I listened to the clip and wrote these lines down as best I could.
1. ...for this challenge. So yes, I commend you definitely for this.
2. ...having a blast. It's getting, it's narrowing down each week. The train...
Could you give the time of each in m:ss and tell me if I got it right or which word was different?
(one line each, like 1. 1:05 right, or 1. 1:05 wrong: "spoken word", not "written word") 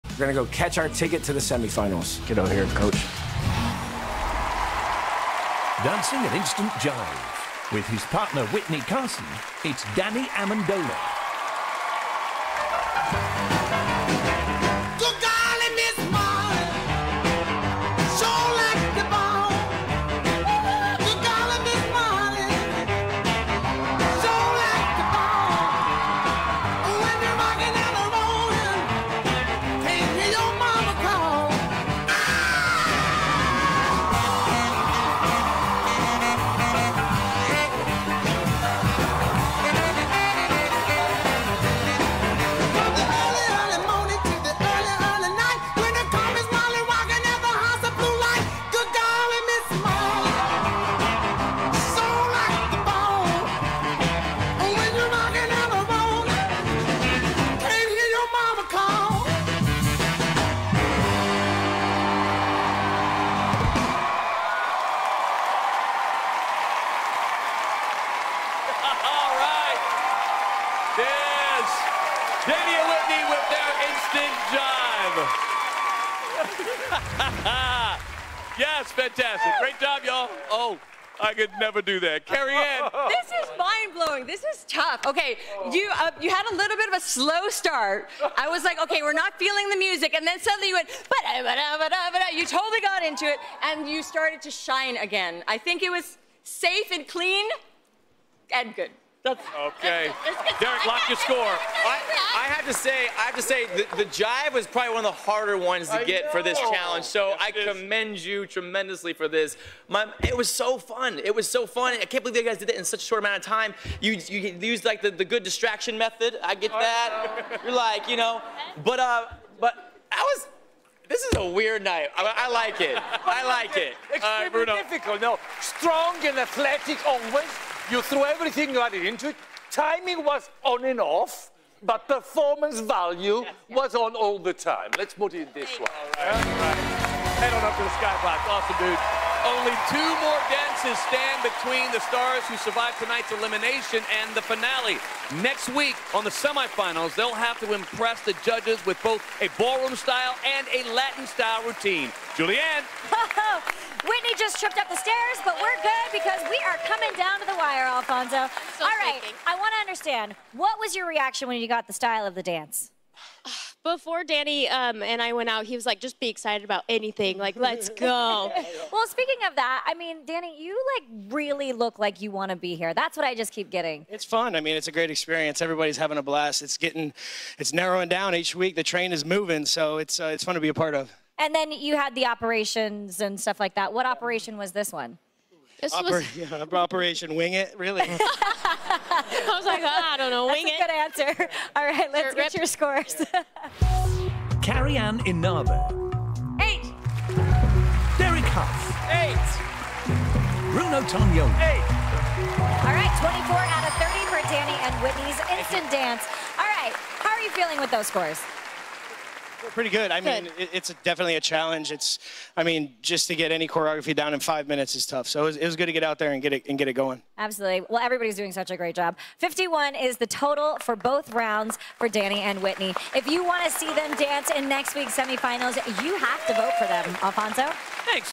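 1. 1:46 wrong: "tremendously", not "definitely"
2. 2:55 right.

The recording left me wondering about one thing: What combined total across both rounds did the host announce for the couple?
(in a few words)
51.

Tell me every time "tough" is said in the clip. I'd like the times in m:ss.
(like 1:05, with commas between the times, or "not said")
1:24, 3:35.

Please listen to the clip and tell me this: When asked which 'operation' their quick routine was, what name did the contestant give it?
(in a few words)
Operation Wing It.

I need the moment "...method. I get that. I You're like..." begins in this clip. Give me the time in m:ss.
1:55.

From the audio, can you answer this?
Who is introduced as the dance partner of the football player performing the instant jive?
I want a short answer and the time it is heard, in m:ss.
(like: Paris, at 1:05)
Witney Carson, at 0:08.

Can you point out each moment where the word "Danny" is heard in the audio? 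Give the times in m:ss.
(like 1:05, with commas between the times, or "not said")
0:09, 2:44, 2:50, 3:24, 3:42.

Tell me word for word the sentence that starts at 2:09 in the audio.
Timing was on and off, but performance value yes, yes.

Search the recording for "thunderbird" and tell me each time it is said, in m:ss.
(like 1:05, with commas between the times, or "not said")
not said.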